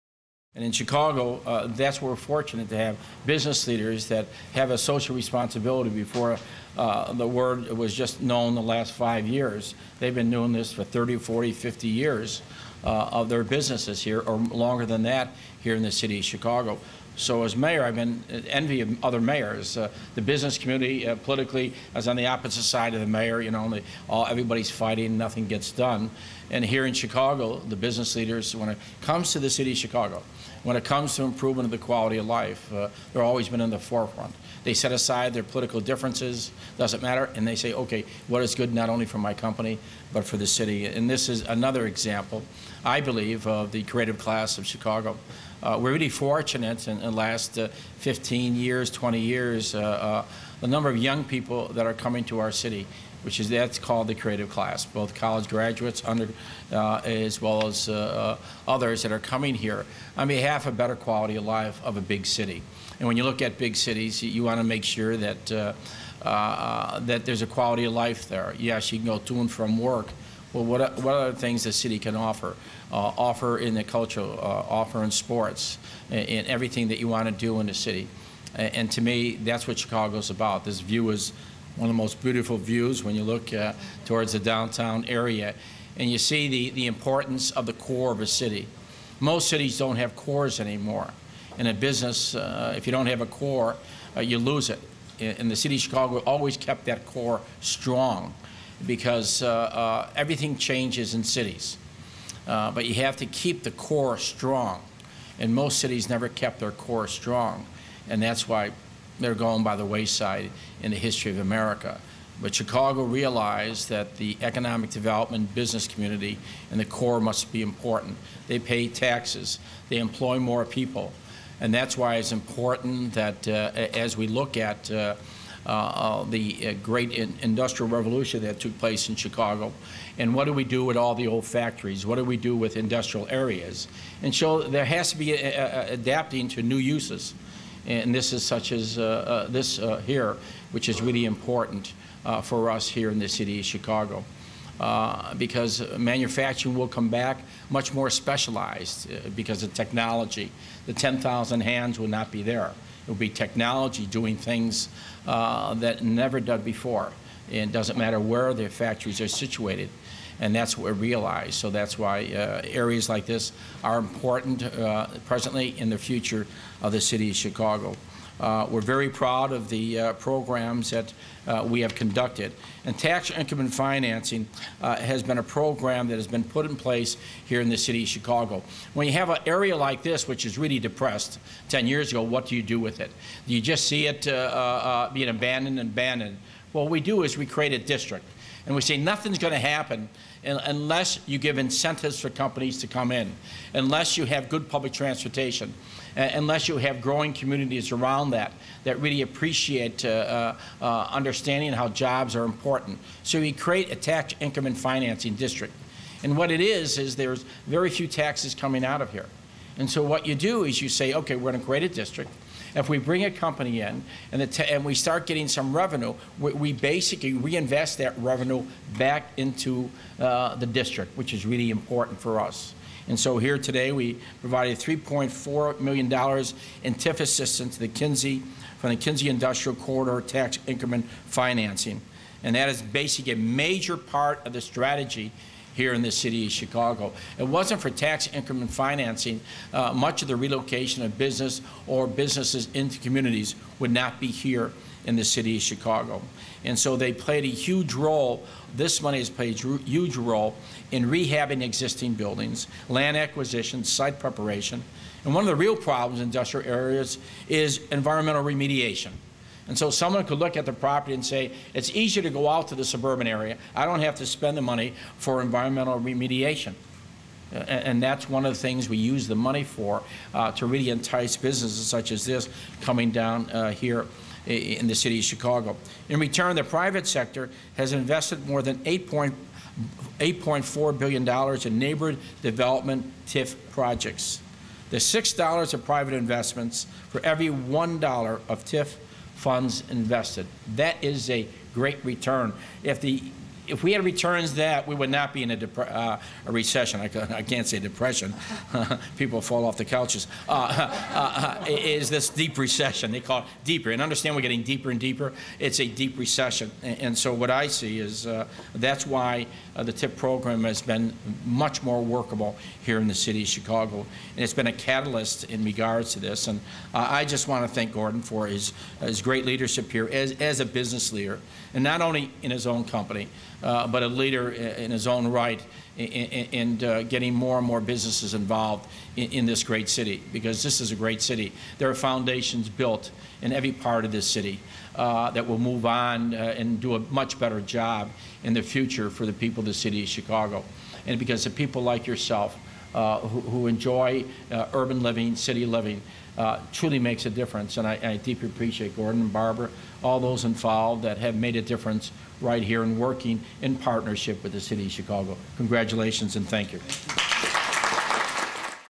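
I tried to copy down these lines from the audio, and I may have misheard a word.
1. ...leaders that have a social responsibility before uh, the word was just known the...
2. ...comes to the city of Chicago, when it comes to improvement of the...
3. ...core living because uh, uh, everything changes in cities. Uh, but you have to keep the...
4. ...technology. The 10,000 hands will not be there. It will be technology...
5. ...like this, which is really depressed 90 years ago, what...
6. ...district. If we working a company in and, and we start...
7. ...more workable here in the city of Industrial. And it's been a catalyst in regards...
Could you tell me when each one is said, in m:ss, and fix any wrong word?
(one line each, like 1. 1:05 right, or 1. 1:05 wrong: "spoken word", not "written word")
1. 0:03 right
2. 0:29 right
3. 1:37 wrong: "strong", not "living"
4. 2:29 right
5. 2:59 wrong: "10", not "90"
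6. 3:31 wrong: "bring", not "working"
7. 5:11 wrong: "Chicago", not "Industrial".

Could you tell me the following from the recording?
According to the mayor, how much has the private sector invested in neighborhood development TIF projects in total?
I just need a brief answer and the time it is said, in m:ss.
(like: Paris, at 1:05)
$8.4 billion, at 4:38.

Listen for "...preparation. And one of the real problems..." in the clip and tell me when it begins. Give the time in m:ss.
4:14.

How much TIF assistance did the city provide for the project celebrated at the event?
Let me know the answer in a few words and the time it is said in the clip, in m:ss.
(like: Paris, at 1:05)
$3.4 million, at 3:44.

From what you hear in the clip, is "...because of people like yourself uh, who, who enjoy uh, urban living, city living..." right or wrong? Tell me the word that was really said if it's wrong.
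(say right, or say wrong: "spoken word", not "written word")
right.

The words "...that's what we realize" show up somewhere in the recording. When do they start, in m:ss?
2:40.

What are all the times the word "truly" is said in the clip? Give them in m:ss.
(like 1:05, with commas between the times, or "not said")
5:46.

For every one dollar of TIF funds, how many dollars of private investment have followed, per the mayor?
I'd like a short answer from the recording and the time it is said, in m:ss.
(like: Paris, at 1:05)
6, at 4:45.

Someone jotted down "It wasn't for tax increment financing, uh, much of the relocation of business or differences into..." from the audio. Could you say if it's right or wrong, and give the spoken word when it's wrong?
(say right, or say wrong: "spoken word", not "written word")
wrong: "businesses", not "differences".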